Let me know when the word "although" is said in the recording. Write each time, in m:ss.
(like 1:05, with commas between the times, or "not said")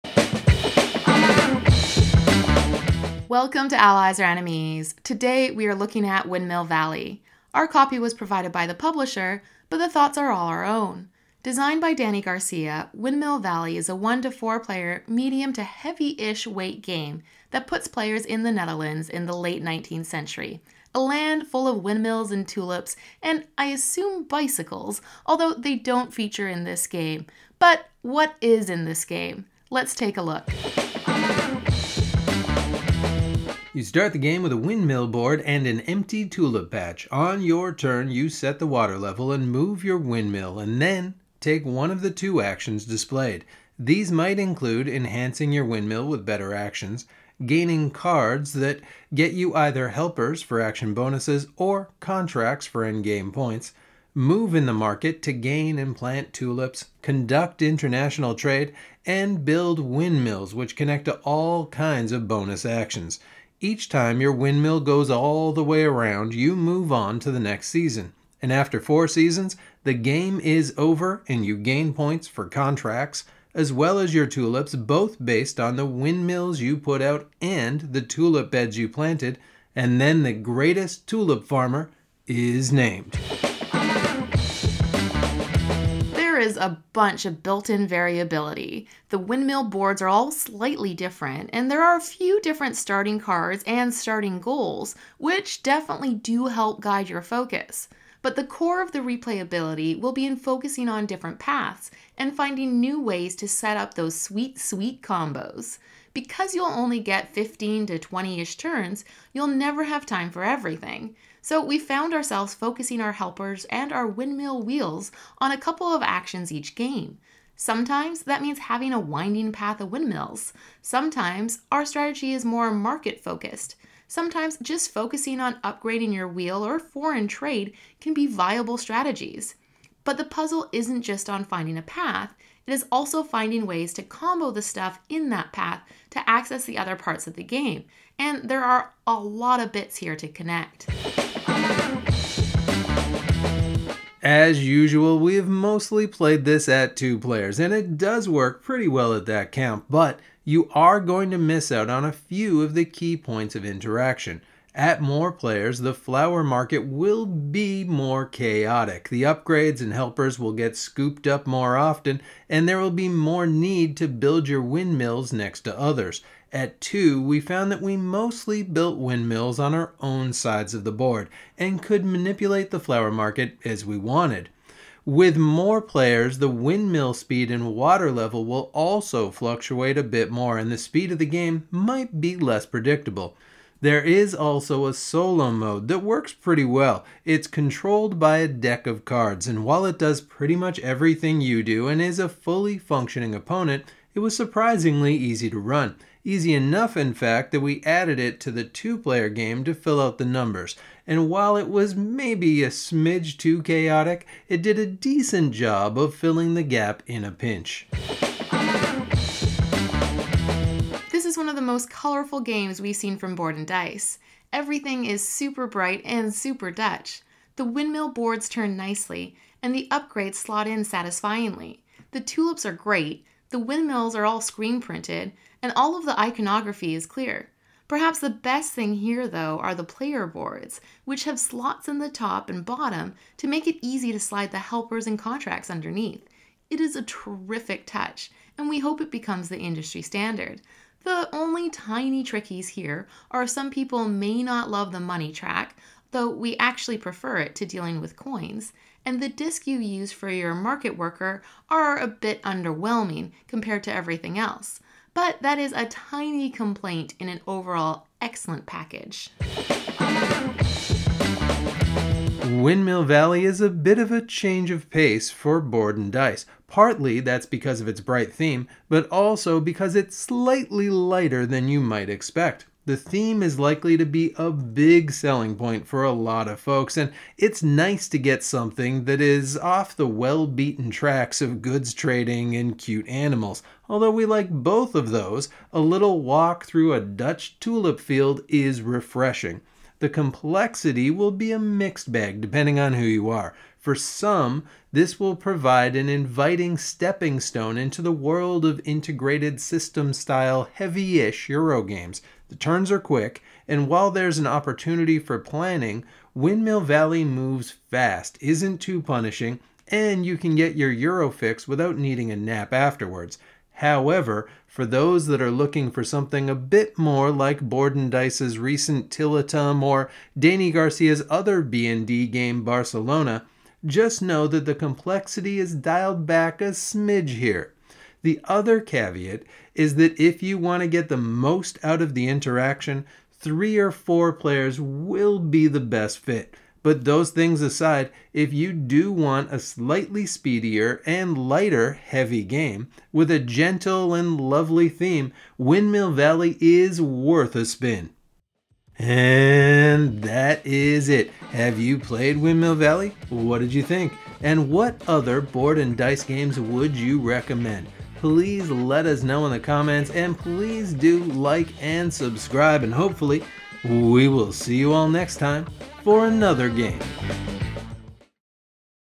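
0:25, 4:43.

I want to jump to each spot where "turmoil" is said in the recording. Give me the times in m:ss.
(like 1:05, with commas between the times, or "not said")
not said.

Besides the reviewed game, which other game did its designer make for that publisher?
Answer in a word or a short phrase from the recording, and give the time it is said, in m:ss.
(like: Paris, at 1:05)
Barcelona, at 5:22.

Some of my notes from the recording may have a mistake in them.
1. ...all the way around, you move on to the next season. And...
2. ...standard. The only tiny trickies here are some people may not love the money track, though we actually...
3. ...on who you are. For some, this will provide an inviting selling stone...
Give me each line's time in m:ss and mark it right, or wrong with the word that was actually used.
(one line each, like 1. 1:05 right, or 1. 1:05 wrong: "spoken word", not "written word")
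1. 1:05 right
2. 4:00 right
3. 4:52 wrong: "stepping", not "selling".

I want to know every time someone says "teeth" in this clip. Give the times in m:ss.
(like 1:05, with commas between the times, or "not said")
not said.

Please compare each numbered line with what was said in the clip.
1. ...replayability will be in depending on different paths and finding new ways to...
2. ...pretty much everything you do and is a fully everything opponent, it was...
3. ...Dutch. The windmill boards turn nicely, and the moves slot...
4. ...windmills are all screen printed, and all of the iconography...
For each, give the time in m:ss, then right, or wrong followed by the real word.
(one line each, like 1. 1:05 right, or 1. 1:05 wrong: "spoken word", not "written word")
1. 1:38 wrong: "focusing", not "depending"
2. 3:10 wrong: "functioning", not "everything"
3. 3:36 wrong: "upgrades", not "moves"
4. 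3:43 right.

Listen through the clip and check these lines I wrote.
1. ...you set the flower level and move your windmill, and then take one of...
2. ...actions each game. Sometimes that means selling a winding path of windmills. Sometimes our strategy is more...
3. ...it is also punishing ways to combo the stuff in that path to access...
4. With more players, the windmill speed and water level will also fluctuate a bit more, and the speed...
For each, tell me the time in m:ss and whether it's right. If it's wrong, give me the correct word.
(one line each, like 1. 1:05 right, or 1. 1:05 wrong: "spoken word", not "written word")
1. 0:38 wrong: "water", not "flower"
2. 1:56 wrong: "having", not "selling"
3. 2:12 wrong: "finding", not "punishing"
4. 2:55 right.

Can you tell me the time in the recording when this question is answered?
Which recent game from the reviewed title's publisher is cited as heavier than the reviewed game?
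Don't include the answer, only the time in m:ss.
5:19.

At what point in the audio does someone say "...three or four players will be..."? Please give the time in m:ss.
5:33.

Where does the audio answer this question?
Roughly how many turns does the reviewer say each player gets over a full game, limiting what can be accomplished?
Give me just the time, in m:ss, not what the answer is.
1:47.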